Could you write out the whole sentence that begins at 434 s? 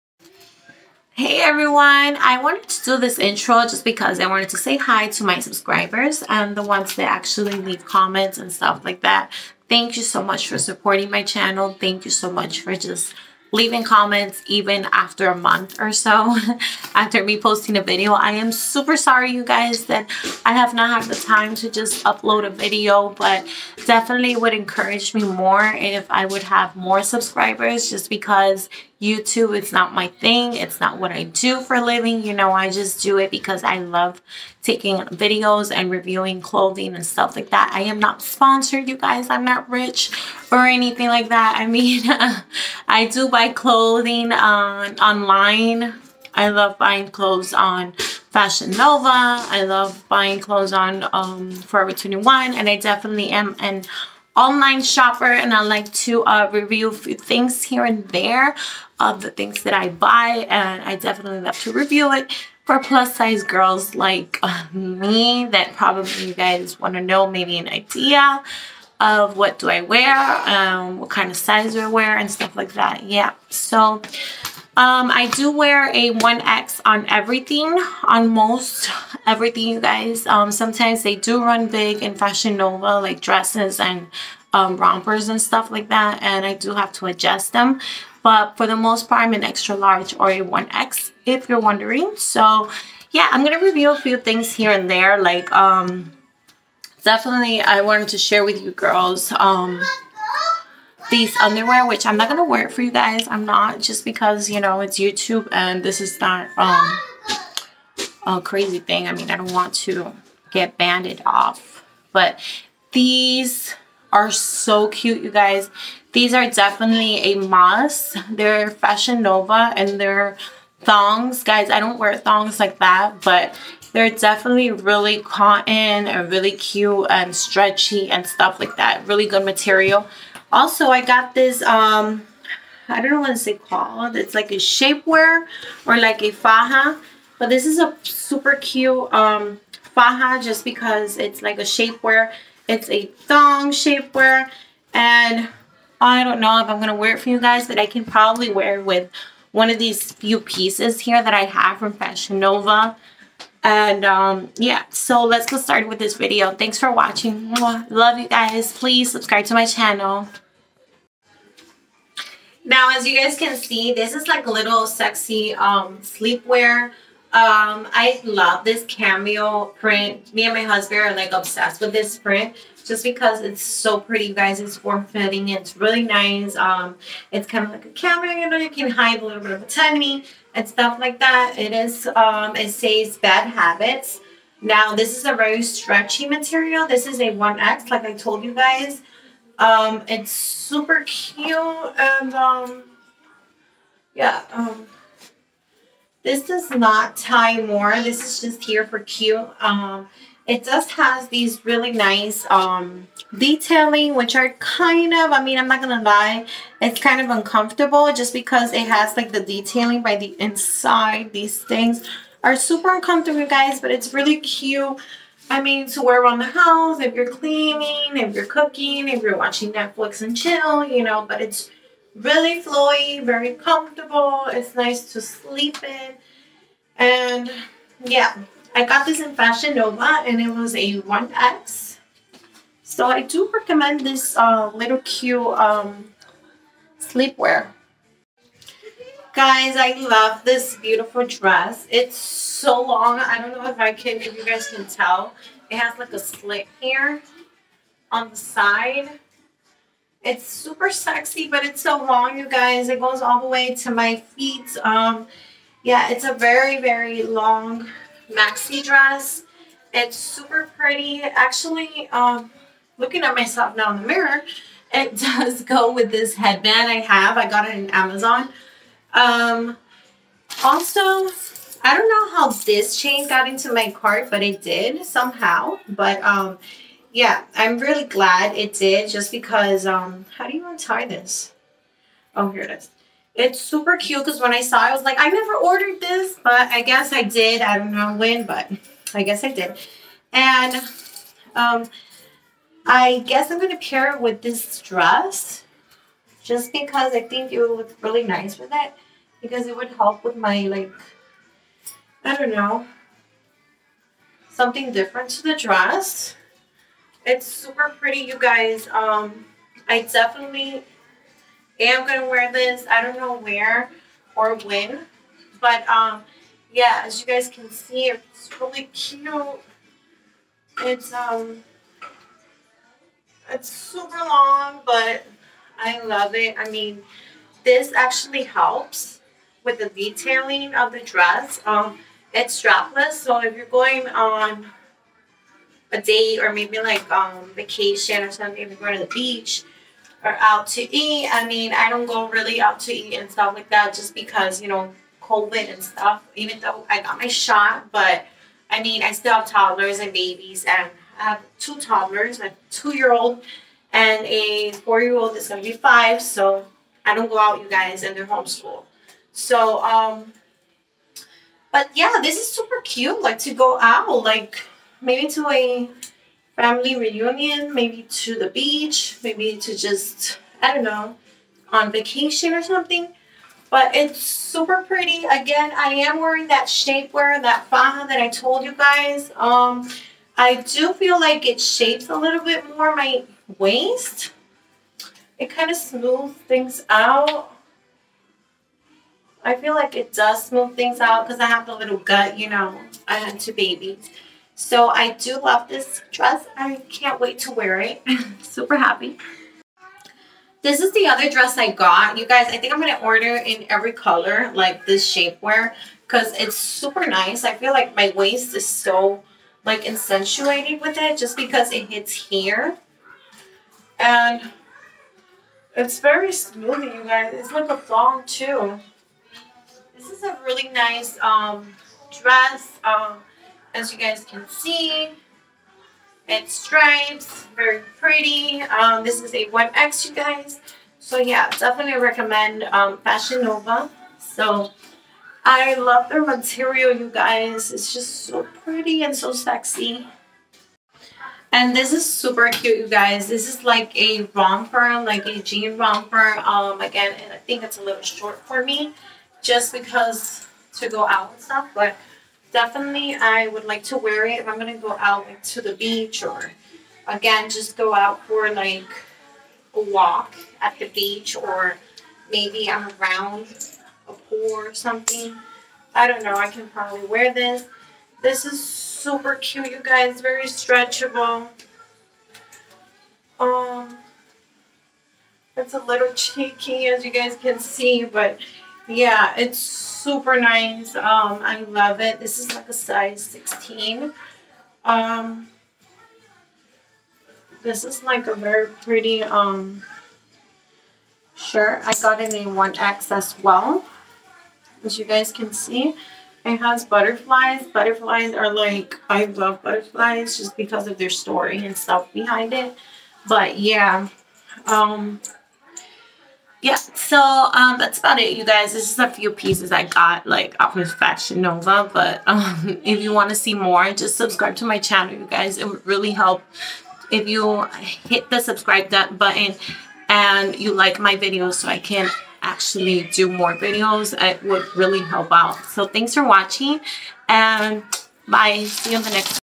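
So I love their material, you guys.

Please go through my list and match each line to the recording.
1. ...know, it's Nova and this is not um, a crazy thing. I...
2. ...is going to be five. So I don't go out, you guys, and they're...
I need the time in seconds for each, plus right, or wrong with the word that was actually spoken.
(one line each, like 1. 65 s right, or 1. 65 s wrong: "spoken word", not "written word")
1. 104 s wrong: "YouTube", not "Nova"
2. 355 s right.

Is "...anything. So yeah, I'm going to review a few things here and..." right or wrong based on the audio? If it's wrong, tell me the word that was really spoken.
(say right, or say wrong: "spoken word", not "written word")
wrong: "wondering", not "anything".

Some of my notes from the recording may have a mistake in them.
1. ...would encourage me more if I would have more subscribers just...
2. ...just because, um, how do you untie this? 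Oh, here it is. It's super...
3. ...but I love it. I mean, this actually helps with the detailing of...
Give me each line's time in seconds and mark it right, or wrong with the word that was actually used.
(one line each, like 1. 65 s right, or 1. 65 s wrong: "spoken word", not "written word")
1. 24 s right
2. 279 s right
3. 324 s right.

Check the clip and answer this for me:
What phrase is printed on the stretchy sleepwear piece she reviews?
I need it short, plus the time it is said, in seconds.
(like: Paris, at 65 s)
bad habits, at 183 s.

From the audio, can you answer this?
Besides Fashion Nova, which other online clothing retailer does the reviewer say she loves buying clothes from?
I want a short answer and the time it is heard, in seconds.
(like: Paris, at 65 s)
Forever 21, at 51 s.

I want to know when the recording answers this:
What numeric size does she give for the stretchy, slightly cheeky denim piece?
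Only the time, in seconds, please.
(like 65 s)
482 s.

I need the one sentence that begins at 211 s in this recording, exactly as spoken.
These things are super uncomfortable, guys, but it's really cute.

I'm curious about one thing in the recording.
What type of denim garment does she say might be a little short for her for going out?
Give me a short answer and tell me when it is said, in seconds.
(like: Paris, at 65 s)
jean romper, at 445 s.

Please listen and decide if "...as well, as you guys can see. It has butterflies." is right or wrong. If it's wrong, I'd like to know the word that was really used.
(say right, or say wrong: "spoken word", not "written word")
right.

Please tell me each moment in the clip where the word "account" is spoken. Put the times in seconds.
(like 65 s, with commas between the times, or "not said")
not said.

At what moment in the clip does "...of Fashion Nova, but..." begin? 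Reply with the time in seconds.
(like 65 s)
510 s.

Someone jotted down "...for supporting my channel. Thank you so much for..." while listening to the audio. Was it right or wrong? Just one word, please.
right.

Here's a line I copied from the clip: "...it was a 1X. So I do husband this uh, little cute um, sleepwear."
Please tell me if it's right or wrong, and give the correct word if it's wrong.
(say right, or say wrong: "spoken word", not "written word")
wrong: "recommend", not "husband".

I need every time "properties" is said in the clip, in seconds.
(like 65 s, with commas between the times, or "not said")
not said.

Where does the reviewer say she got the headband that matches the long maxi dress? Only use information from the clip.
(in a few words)
Amazon.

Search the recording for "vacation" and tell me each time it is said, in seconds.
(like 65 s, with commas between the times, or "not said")
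337 s, 371 s.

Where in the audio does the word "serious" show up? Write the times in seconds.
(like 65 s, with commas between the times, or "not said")
not said.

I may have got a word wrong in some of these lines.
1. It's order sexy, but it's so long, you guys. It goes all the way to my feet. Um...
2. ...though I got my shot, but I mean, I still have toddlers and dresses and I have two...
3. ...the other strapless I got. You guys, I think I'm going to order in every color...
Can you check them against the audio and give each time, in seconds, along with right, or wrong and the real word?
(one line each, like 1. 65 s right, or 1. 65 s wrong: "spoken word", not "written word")
1. 250 s wrong: "super", not "order"
2. 346 s wrong: "babies", not "dresses"
3. 400 s wrong: "dress", not "strapless".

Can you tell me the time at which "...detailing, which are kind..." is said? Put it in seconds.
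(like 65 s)
203 s.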